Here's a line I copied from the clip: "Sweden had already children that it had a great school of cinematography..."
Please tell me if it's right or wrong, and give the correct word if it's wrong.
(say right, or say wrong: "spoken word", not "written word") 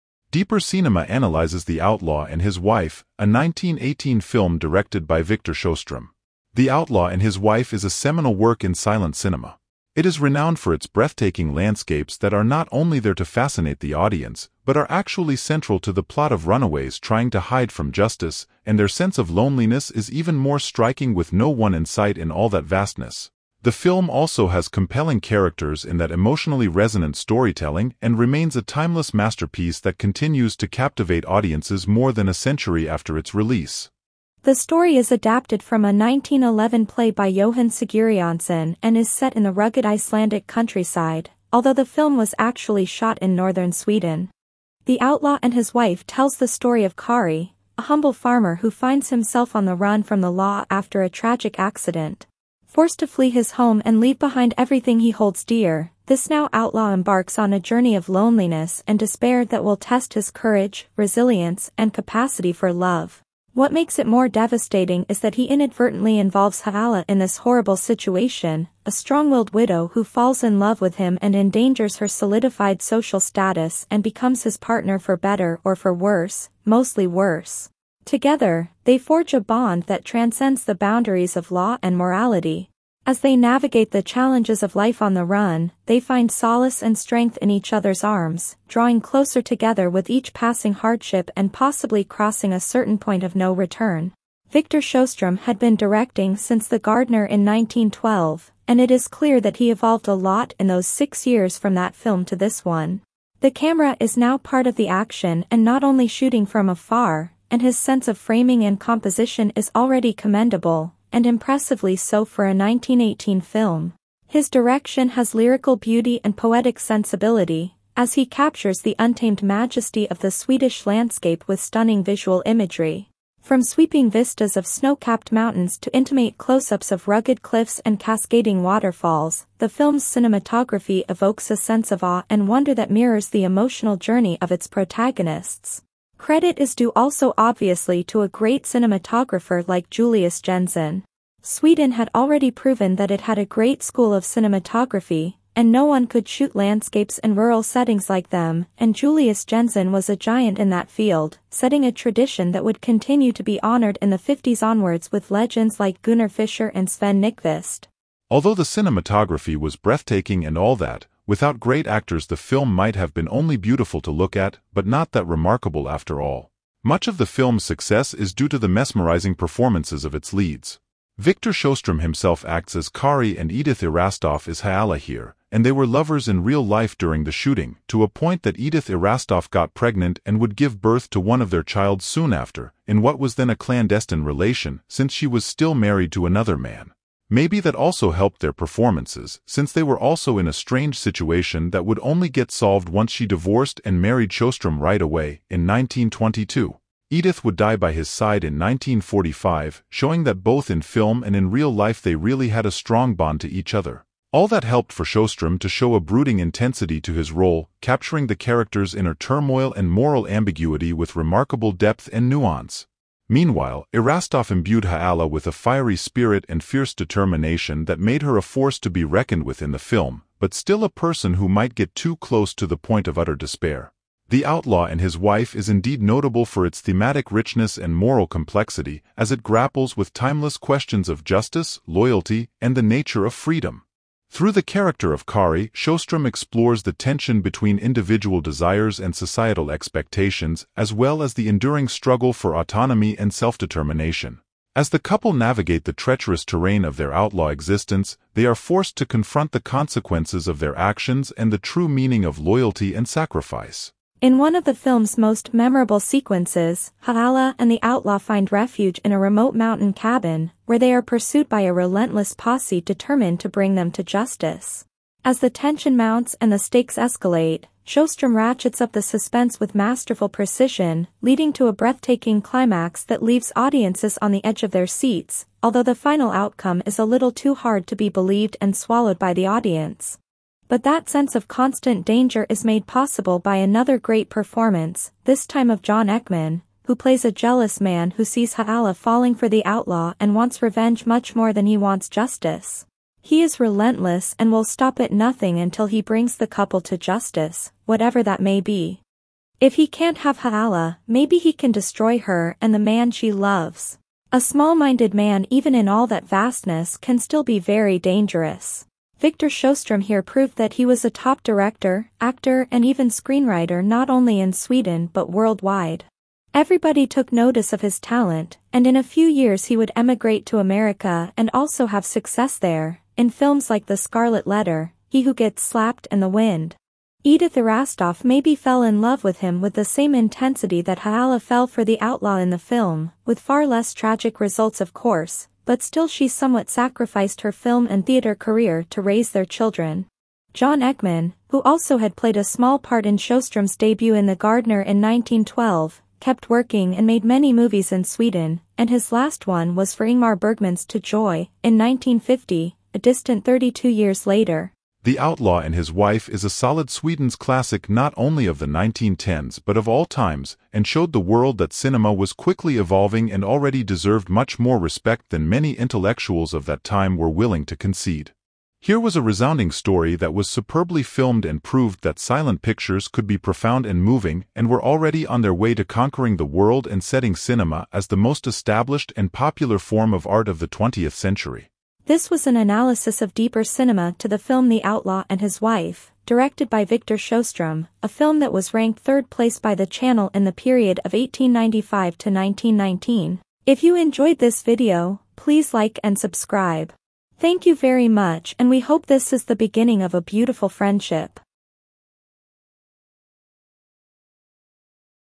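wrong: "proven", not "children".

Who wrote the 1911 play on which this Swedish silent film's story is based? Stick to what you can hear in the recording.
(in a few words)
Johan Sigurjonsson.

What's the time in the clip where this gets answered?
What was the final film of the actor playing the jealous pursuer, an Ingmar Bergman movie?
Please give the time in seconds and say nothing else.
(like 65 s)
350 s.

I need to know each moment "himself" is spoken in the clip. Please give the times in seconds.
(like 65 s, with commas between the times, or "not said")
49 s, 172 s.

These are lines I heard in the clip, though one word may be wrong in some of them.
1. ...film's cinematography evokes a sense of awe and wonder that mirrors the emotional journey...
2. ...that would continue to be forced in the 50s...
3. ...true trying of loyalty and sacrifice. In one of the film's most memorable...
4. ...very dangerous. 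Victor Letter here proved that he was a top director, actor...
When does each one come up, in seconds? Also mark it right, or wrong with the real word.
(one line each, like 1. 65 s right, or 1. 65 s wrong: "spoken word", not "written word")
1. 129 s right
2. 152 s wrong: "honored", not "forced"
3. 251 s wrong: "meaning", not "trying"
4. 307 s wrong: "Sjostrom", not "Letter".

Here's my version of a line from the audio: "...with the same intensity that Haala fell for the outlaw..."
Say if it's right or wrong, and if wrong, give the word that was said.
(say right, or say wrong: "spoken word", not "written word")
right.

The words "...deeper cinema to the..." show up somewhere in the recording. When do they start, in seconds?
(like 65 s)
383 s.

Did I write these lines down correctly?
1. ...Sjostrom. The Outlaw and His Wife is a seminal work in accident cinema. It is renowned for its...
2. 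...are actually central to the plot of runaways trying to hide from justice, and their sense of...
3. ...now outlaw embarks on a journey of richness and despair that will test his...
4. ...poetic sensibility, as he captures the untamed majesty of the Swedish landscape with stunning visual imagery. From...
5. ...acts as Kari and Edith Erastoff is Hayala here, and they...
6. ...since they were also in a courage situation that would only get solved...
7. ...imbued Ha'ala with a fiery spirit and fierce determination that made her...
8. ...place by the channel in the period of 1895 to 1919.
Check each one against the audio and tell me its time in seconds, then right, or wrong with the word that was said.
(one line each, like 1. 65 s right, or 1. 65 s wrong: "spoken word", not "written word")
1. 5 s wrong: "silent", not "accident"
2. 14 s right
3. 56 s wrong: "loneliness", not "richness"
4. 116 s right
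5. 172 s right
6. 189 s wrong: "strange", not "courage"
7. 214 s right
8. 389 s right.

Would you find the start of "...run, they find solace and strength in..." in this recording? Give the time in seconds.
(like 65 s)
85 s.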